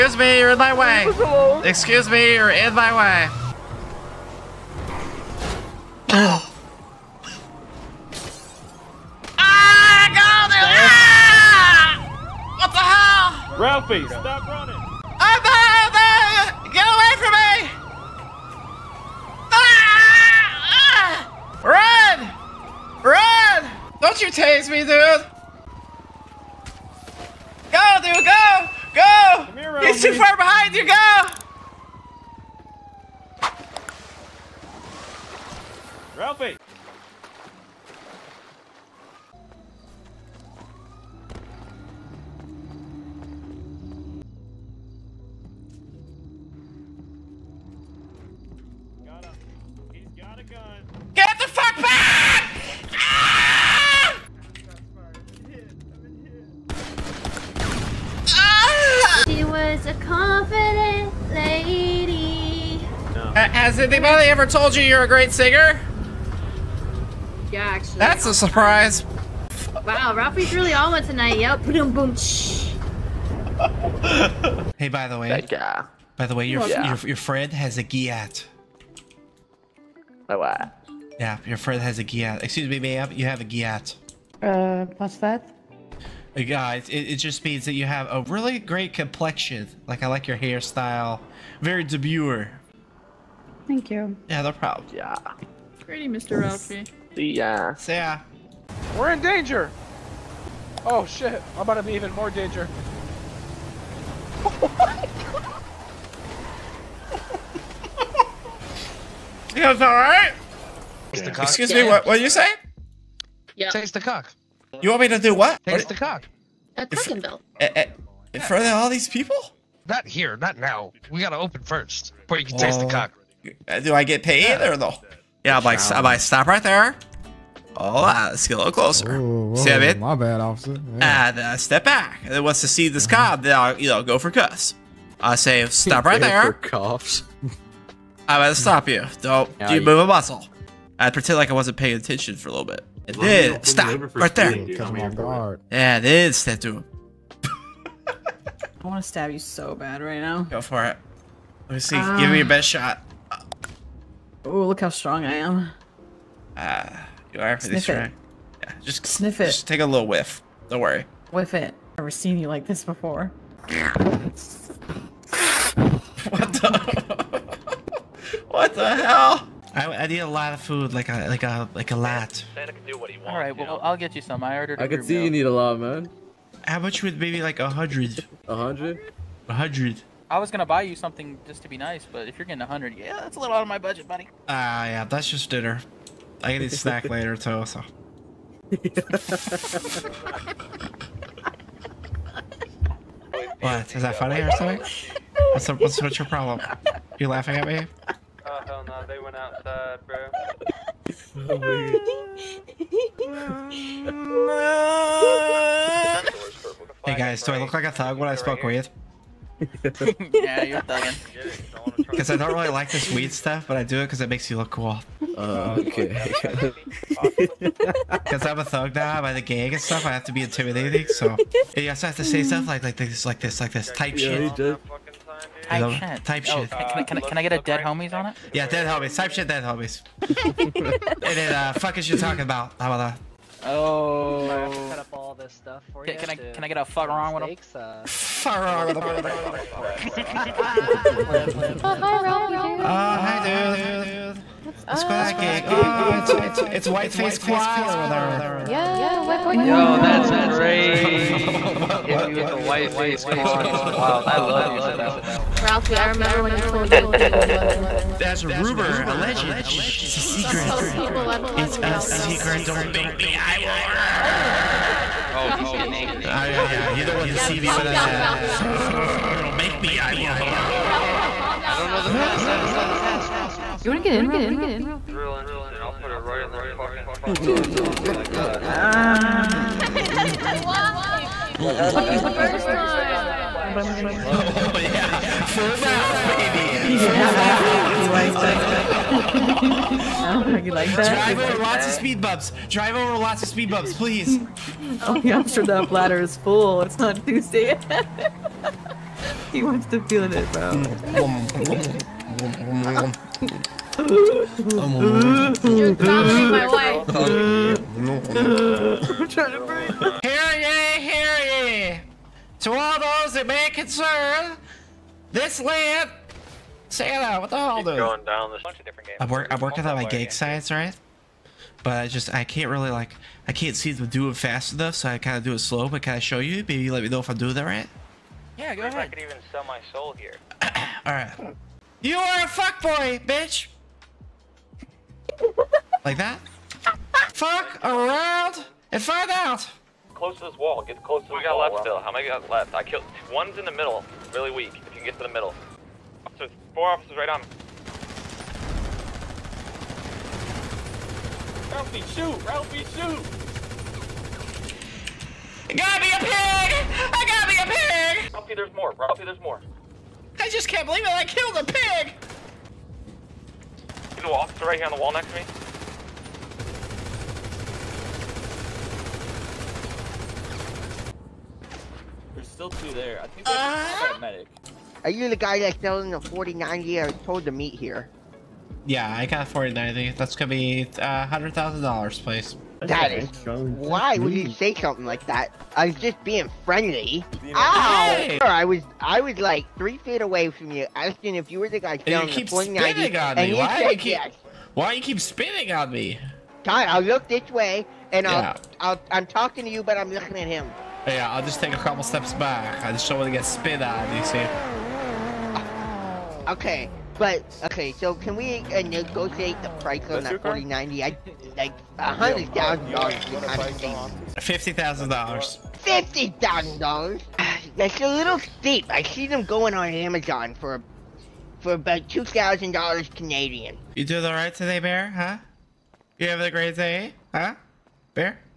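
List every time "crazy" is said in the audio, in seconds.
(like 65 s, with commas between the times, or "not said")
250 s.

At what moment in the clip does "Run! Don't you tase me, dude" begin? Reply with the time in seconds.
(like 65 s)
23 s.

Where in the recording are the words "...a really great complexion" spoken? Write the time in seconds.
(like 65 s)
88 s.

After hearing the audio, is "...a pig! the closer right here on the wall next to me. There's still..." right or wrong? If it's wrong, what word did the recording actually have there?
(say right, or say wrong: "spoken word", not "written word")
wrong: "officer", not "closer".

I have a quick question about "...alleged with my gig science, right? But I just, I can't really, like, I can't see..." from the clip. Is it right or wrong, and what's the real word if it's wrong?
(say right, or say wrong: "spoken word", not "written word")
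wrong: "worked", not "alleged".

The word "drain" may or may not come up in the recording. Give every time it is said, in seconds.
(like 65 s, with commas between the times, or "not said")
not said.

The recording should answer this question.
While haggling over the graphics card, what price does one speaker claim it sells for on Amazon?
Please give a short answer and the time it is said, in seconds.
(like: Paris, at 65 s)
$2,000 Canadian, at 422 s.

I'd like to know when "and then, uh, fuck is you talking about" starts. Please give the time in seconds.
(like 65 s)
230 s.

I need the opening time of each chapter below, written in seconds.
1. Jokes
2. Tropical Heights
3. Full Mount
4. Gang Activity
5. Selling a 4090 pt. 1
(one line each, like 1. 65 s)
1. 58 s
2. 168 s
3. 254 s
4. 317 s
5. 373 s.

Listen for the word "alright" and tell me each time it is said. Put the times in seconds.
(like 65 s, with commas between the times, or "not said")
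109 s, 331 s.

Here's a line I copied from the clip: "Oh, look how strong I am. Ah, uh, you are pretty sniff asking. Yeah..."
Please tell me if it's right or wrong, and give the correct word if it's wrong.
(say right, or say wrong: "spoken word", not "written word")
wrong: "strong", not "asking".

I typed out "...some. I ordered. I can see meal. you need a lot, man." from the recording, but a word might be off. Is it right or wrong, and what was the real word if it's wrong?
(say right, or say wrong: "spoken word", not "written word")
right.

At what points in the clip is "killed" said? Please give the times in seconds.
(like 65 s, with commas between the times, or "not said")
257 s, 342 s, 361 s.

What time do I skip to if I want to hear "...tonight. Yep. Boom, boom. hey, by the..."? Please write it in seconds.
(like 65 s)
71 s.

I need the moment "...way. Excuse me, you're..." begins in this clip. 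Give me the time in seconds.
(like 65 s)
0 s.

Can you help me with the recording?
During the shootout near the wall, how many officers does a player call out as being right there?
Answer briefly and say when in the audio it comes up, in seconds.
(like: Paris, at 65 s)
4, at 346 s.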